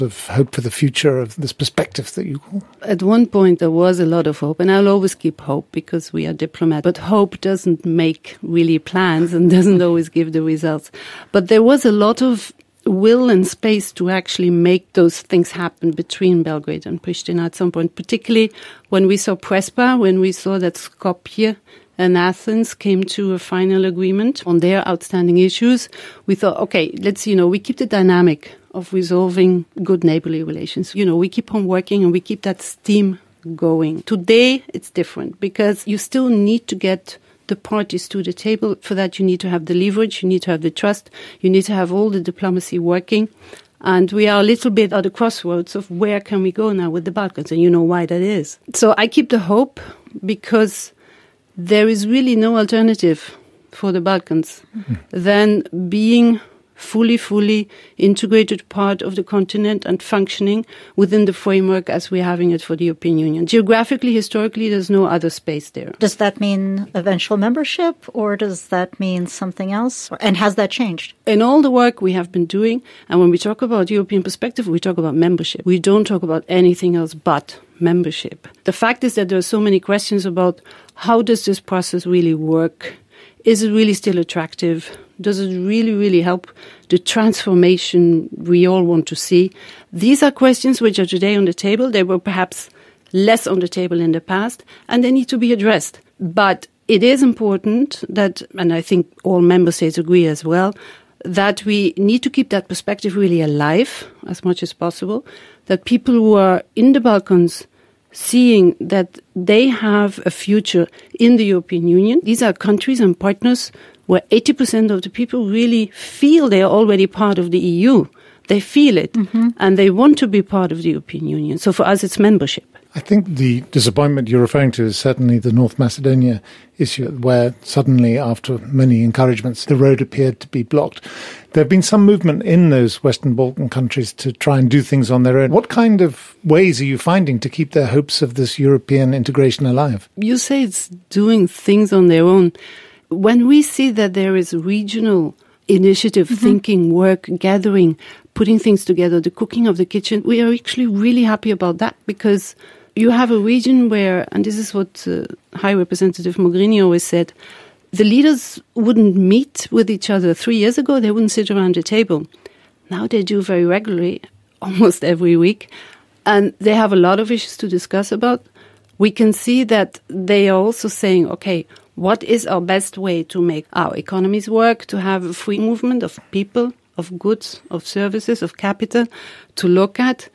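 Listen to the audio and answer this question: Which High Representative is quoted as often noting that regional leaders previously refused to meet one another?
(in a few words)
Mogherini.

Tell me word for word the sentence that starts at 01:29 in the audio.
These are questions which are today on the table.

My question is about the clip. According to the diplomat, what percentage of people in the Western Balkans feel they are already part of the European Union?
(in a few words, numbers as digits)
80%.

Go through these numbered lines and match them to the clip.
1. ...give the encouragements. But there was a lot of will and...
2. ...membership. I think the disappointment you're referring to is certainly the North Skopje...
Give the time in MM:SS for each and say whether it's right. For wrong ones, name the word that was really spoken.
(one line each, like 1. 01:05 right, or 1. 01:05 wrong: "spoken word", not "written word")
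1. 00:10 wrong: "results", not "encouragements"
2. 02:02 wrong: "Macedonia", not "Skopje".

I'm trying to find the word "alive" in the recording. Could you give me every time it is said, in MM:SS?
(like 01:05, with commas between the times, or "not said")
01:43, 02:19.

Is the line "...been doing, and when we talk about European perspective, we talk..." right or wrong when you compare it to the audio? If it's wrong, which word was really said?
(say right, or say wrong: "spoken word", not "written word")
right.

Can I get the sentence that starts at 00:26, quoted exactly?
We thought, okay, let's, you know, we keep the dynamic of resolving good neighborly relations.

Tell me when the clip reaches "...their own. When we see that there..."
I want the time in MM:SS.
02:22.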